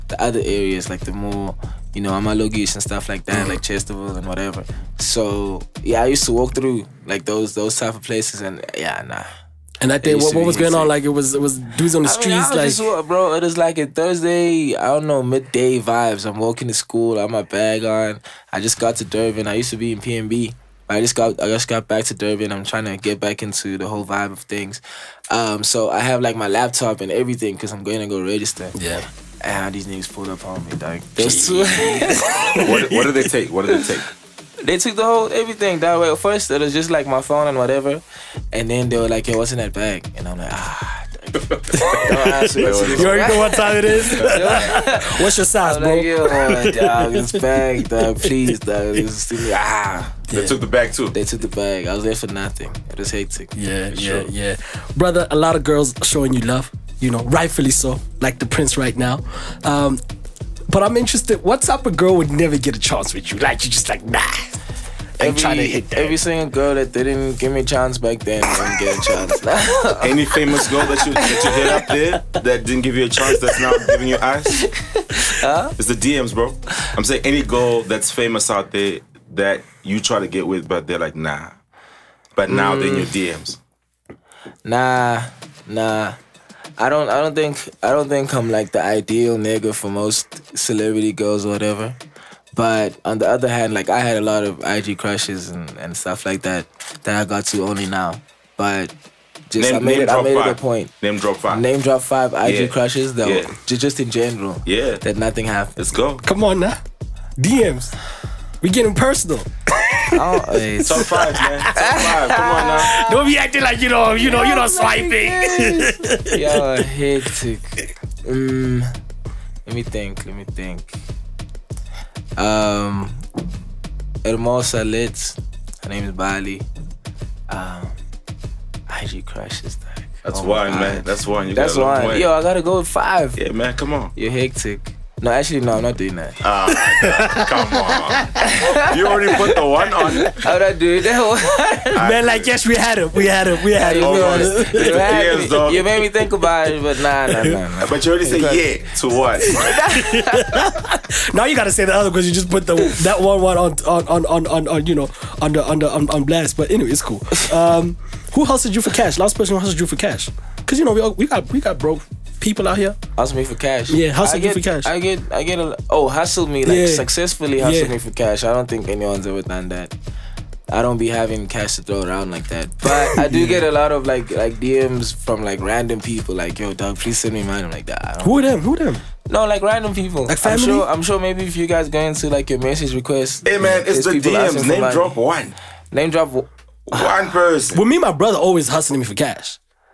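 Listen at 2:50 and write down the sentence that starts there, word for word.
I don't be having cash to throw around like that.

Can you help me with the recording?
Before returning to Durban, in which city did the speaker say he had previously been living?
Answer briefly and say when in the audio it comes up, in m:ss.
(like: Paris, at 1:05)
PMB, at 0:19.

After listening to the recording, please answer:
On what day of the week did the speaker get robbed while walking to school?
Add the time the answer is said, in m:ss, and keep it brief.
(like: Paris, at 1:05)
Thursday, at 0:13.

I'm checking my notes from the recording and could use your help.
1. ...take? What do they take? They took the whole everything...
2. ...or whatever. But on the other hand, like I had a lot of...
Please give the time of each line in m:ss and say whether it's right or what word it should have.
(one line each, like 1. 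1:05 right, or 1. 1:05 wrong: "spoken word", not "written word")
1. 0:33 right
2. 1:31 right.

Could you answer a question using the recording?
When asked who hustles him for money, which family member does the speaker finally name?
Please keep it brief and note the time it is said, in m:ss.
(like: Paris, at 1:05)
my brother, at 3:08.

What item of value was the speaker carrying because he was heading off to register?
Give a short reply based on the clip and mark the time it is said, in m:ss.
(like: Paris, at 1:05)
laptop, at 0:26.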